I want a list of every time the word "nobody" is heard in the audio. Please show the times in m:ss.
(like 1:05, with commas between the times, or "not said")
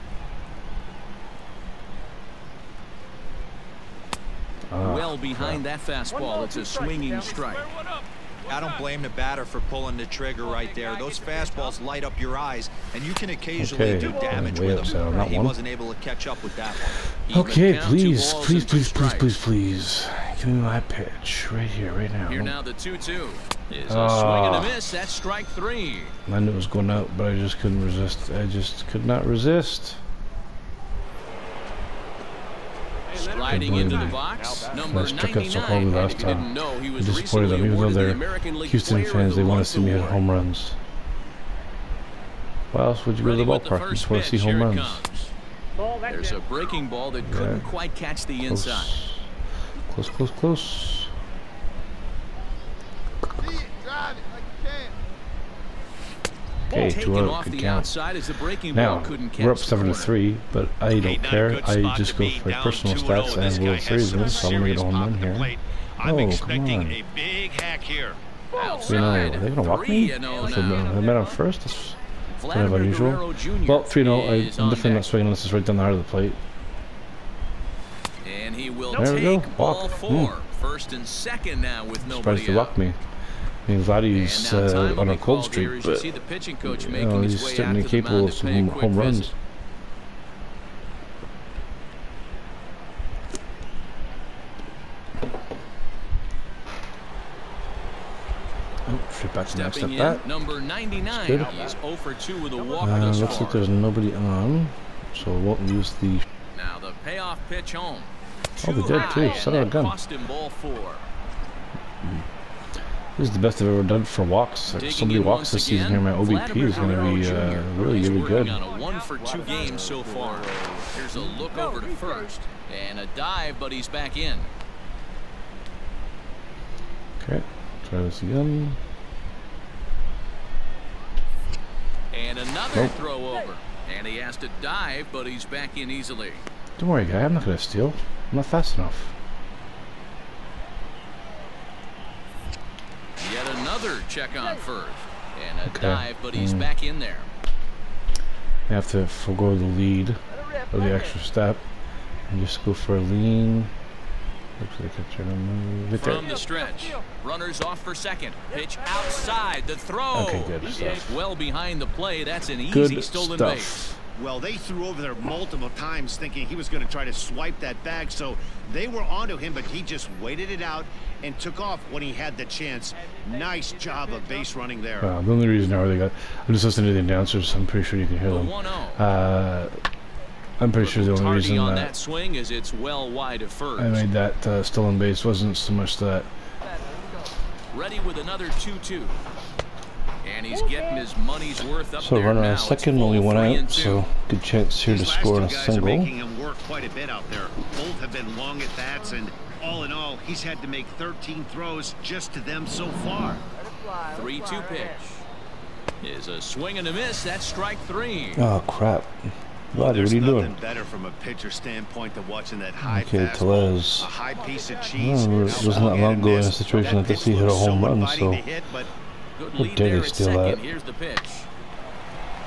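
1:22, 1:43.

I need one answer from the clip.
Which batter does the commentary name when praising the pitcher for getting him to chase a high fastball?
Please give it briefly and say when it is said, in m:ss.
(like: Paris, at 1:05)
Tellez, at 3:33.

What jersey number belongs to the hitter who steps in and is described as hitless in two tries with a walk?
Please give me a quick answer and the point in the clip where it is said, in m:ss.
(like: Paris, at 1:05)
99, at 1:40.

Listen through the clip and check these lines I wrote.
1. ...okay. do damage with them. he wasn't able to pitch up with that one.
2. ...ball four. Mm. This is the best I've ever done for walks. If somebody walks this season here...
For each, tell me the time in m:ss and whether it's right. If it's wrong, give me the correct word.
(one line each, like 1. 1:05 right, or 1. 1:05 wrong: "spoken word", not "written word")
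1. 0:13 wrong: "catch", not "pitch"
2. 1:50 right.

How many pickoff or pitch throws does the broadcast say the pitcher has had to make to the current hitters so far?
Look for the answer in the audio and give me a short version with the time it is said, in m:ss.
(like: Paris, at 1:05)
13, at 3:20.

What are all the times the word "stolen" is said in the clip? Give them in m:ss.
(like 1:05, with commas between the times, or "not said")
2:43, 3:04.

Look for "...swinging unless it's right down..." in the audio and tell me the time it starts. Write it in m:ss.
1:15.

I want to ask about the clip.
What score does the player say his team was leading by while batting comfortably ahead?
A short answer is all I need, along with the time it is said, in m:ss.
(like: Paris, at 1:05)
7 to 3, at 0:59.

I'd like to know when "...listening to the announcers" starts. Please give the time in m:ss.
2:56.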